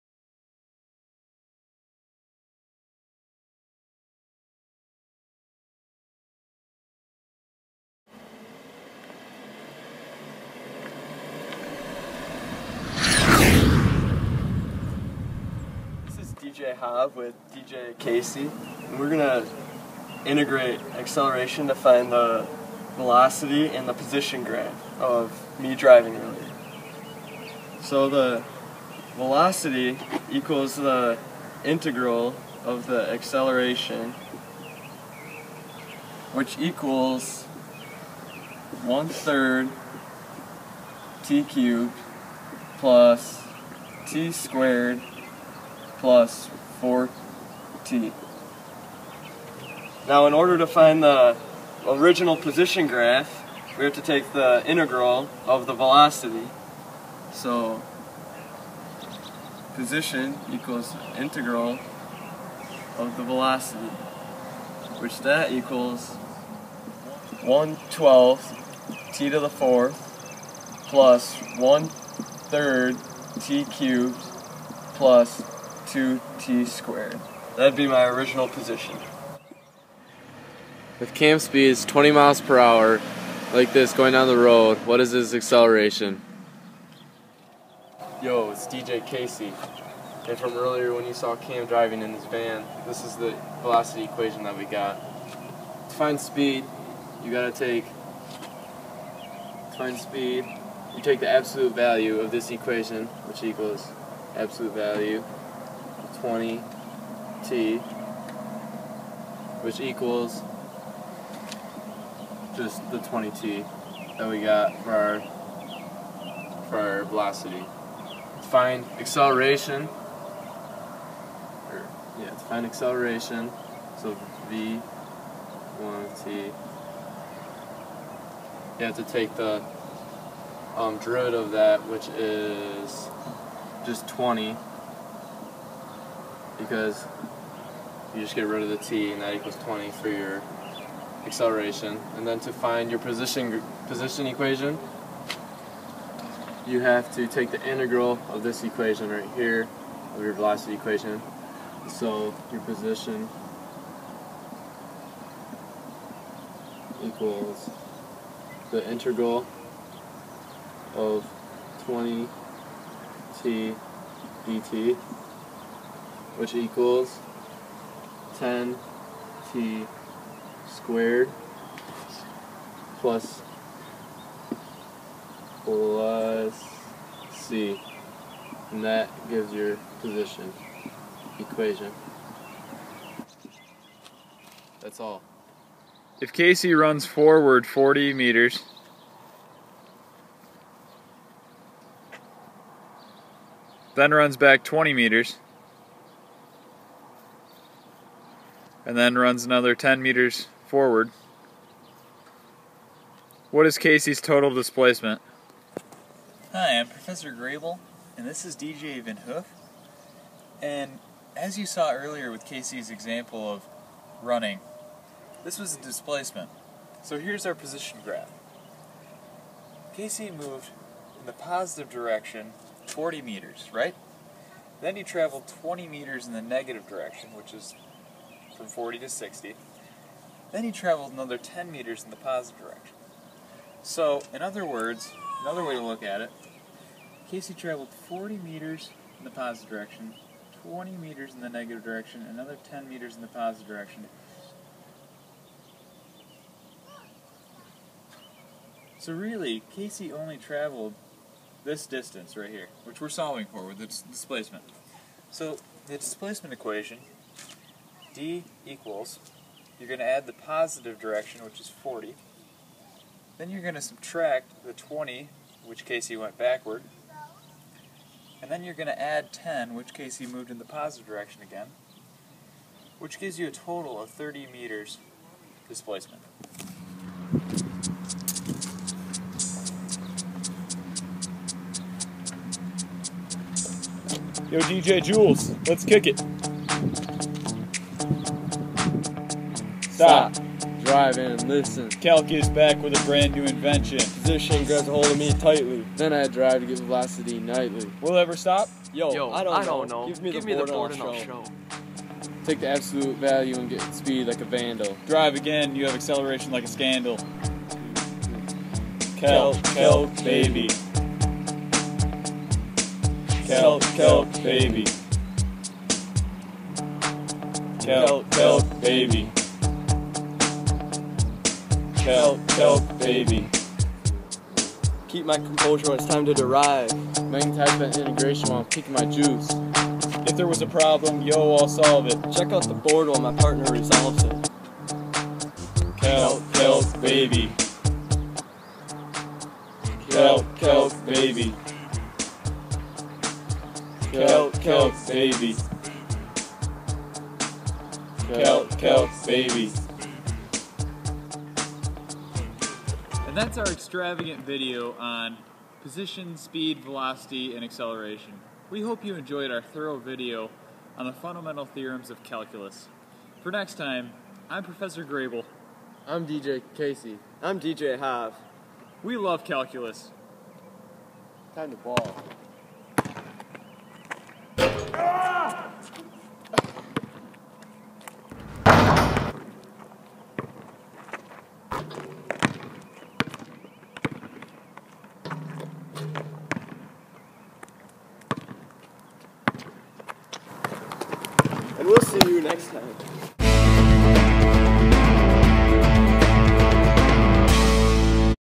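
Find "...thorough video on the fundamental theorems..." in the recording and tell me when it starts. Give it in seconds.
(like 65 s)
359 s.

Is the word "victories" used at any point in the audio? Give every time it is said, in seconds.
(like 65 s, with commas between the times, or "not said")
not said.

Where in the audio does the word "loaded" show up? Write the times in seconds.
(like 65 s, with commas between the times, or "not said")
not said.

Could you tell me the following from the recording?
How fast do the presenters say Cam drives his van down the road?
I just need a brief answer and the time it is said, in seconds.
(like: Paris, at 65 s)
20 miles per hour, at 81 s.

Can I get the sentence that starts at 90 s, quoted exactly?
And from earlier when you saw Cam driving in his van, this is the velocity equation that we got.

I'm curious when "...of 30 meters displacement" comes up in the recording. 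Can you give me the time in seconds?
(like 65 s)
274 s.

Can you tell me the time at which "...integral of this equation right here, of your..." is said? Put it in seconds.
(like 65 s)
147 s.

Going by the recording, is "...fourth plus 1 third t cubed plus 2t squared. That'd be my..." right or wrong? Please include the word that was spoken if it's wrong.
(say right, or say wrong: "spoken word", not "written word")
right.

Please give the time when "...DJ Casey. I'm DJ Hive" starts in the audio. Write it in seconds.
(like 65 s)
366 s.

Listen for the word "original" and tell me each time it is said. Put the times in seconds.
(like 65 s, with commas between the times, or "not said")
51 s, 78 s.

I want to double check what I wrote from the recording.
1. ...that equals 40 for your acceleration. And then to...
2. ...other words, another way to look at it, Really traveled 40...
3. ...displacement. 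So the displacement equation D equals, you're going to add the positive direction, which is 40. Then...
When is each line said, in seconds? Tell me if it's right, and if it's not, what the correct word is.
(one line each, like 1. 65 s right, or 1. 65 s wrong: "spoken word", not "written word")
1. 139 s wrong: "20", not "40"
2. 234 s wrong: "Casey", not "Really"
3. 254 s right.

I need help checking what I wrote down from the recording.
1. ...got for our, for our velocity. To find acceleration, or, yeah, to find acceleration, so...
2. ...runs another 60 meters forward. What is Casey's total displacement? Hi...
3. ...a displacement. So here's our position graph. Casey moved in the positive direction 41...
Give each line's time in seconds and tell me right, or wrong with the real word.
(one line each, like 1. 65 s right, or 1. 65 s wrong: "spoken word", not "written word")
1. 114 s right
2. 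199 s wrong: "10", not "60"
3. 215 s wrong: "40", not "41".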